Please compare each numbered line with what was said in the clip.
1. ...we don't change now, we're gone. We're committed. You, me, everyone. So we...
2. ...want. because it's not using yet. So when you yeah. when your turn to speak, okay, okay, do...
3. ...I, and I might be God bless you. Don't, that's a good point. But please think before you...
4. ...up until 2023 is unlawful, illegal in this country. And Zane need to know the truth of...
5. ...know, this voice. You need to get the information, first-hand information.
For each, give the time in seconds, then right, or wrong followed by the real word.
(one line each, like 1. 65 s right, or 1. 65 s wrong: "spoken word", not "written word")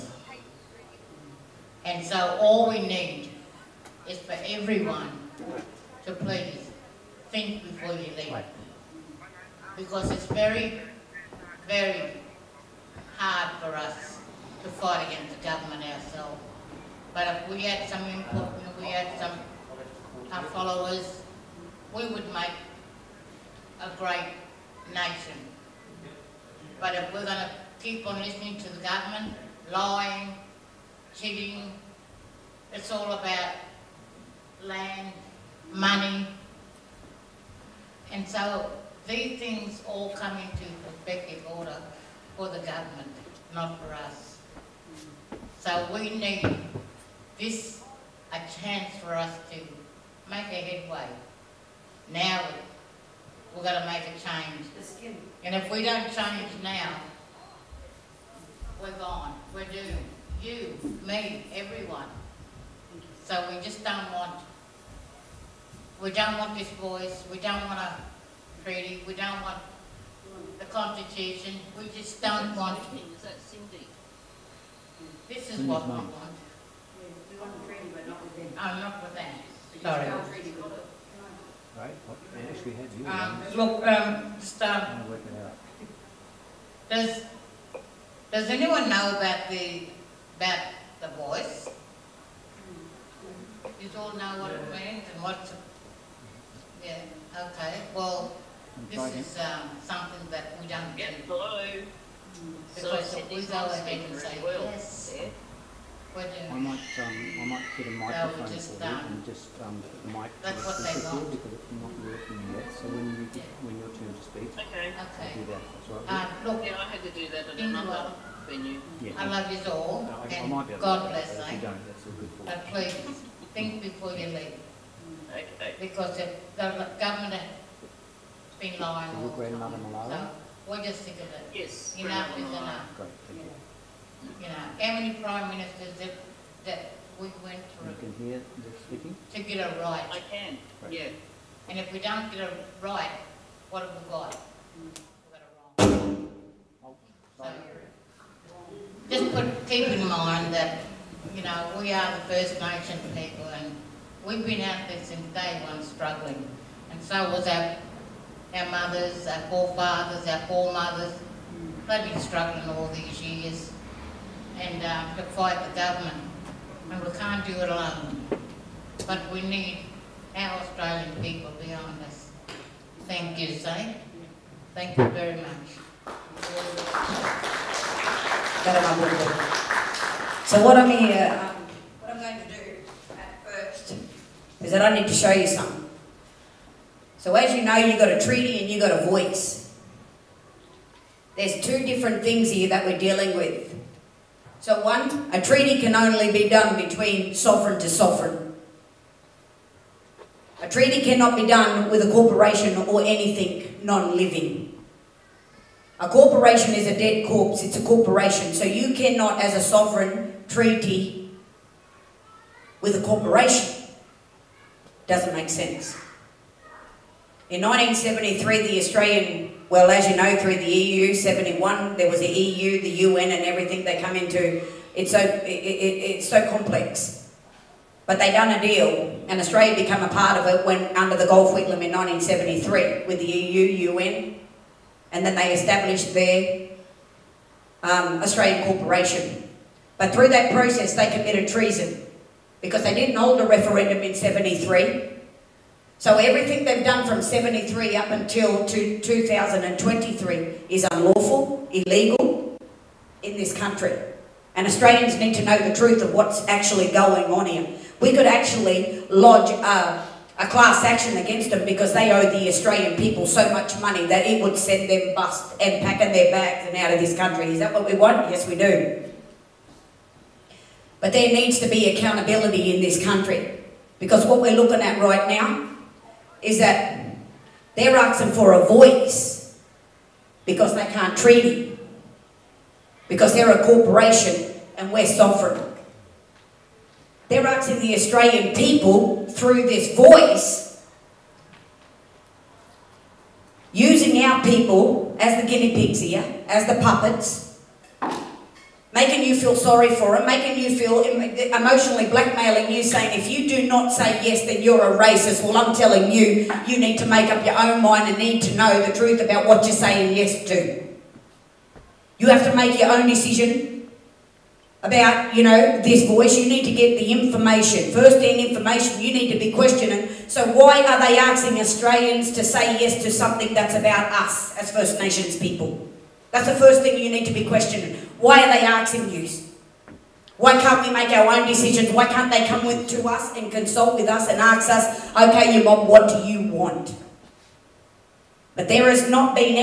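1. 55 s wrong: "doomed", not "committed"
2. 111 s wrong: "working", not "using"
3. 120 s right
4. 247 s wrong: "Australians", not "Zane"
5. 315 s right.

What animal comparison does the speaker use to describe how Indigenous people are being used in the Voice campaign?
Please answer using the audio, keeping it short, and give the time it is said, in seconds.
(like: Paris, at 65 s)
Guinea pigs, at 295 s.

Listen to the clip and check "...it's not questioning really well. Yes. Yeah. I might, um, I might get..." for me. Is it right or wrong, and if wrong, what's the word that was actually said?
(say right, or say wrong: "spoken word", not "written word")
wrong: "speaking", not "questioning".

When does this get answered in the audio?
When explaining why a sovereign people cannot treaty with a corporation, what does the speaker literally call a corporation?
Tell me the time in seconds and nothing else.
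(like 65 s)
206 s.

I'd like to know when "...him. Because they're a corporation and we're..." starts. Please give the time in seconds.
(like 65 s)
281 s.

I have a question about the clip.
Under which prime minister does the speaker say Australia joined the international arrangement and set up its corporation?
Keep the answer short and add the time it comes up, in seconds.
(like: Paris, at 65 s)
Gough Whitlam, at 231 s.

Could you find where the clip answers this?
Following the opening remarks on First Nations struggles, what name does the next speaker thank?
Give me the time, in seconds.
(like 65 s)
173 s.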